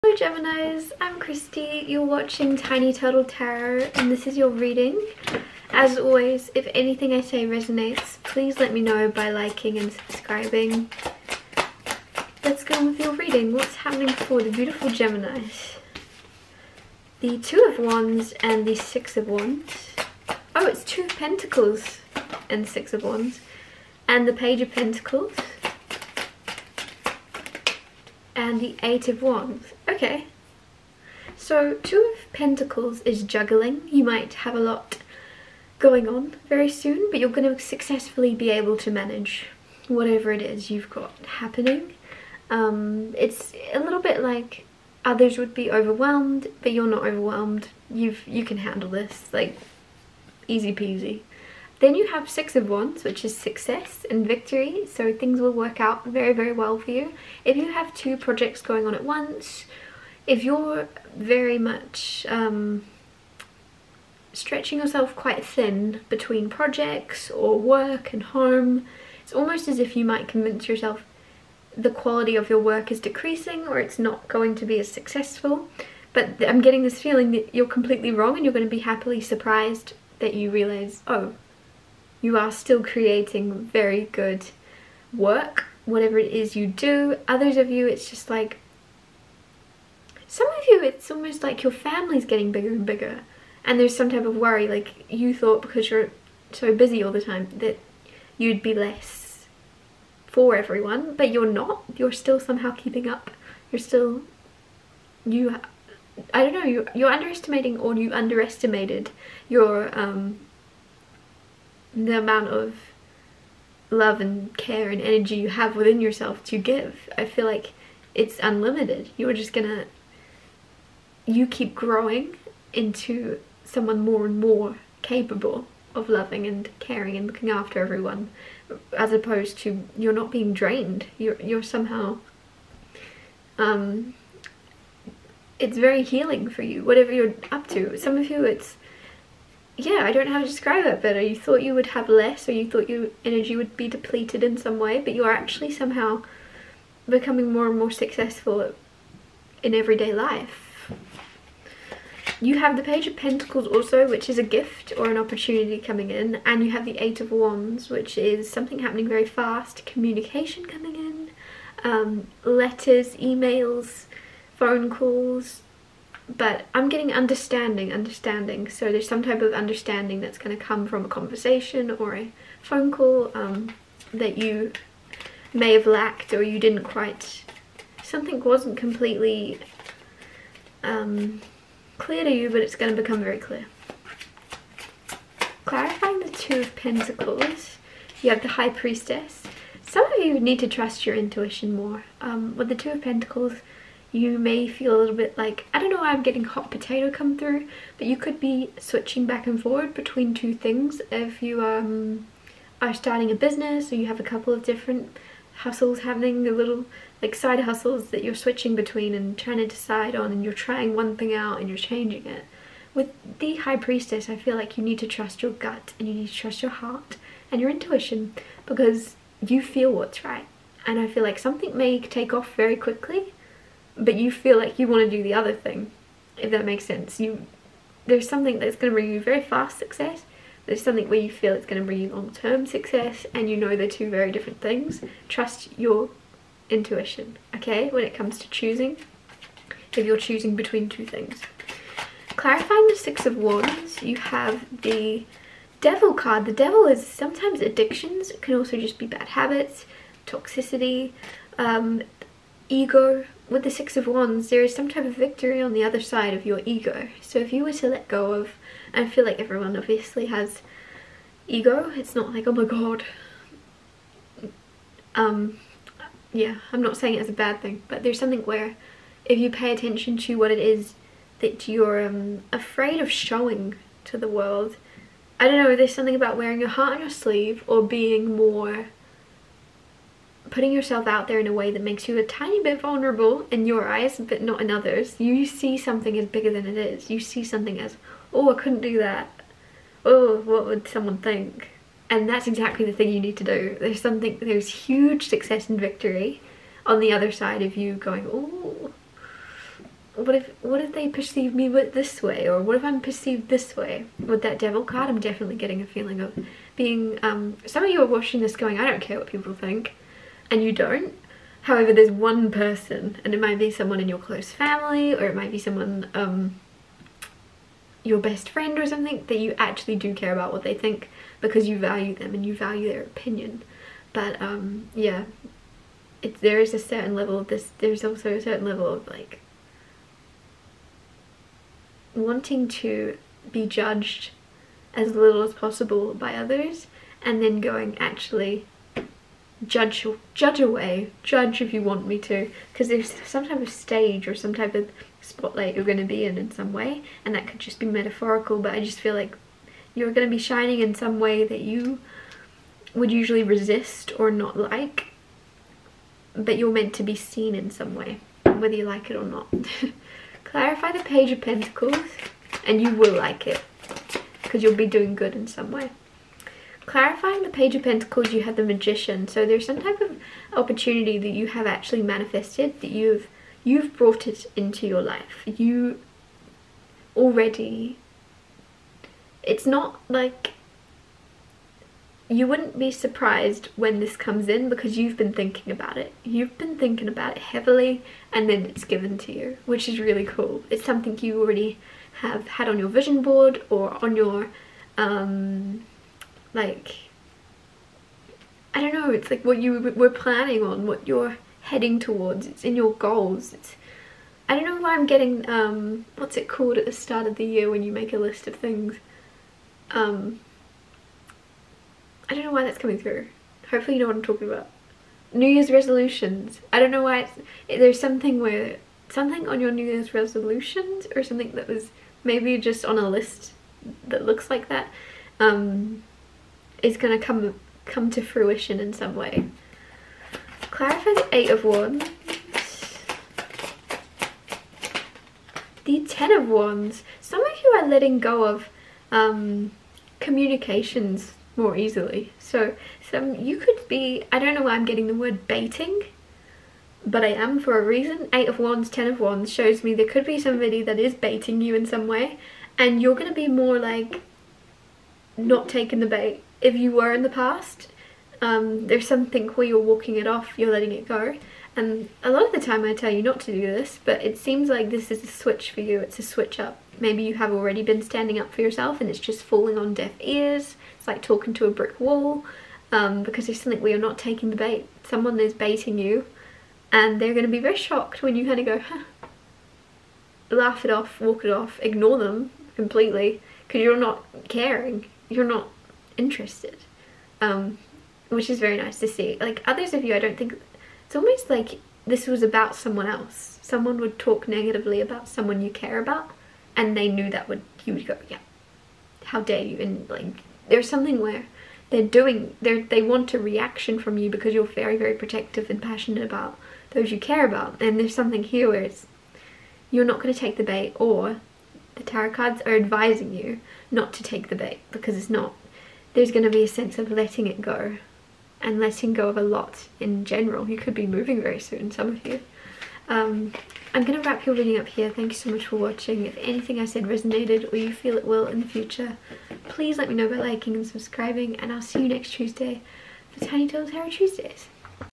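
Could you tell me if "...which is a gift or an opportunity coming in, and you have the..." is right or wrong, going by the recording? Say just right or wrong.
right.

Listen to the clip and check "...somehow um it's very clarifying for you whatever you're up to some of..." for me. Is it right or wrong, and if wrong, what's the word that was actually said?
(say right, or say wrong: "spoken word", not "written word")
wrong: "healing", not "clarifying".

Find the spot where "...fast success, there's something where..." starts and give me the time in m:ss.
3:49.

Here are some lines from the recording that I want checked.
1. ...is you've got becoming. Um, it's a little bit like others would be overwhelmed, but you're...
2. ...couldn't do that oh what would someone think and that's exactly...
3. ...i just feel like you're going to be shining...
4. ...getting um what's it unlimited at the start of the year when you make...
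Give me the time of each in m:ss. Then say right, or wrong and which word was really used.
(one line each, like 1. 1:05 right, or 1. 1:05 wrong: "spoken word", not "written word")
1. 0:40 wrong: "happening", not "becoming"
2. 4:48 right
3. 5:48 right
4. 6:45 wrong: "called", not "unlimited".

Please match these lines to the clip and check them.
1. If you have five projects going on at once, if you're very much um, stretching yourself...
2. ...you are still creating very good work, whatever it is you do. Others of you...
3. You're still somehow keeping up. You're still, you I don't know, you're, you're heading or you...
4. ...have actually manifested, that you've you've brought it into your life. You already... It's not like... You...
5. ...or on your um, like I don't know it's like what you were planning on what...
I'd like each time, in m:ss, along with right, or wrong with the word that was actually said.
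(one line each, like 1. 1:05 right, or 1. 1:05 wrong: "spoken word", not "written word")
1. 0:57 wrong: "two", not "five"
2. 1:22 right
3. 1:41 wrong: "underestimating", not "heading"
4. 6:11 right
5. 6:33 right.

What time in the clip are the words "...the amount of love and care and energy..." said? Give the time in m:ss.
1:51.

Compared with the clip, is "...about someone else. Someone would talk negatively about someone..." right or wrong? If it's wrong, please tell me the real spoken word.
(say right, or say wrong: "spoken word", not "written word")
right.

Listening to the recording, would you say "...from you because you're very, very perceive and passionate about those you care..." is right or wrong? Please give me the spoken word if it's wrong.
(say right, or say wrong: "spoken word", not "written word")
wrong: "protective", not "perceive".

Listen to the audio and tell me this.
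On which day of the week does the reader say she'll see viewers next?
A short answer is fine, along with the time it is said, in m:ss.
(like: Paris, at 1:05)
Tuesday, at 8:52.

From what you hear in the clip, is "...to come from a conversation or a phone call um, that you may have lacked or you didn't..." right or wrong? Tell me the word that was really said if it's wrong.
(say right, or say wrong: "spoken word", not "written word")
right.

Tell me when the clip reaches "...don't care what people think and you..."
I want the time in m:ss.
5:08.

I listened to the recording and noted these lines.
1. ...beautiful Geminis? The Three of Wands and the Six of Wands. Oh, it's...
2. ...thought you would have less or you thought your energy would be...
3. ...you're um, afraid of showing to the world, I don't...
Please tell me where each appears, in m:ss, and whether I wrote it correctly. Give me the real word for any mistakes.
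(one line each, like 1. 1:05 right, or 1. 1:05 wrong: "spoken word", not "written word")
1. 0:14 wrong: "Two", not "Three"
2. 2:21 right
3. 4:31 right.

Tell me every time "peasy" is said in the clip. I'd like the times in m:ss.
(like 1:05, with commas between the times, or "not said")
0:50.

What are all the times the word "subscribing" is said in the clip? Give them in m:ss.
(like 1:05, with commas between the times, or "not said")
0:09, 8:50.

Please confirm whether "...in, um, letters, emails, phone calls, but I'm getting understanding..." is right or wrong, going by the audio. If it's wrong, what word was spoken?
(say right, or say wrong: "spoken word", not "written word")
right.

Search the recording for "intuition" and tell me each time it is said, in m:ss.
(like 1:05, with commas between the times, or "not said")
3:11, 3:37, 3:56.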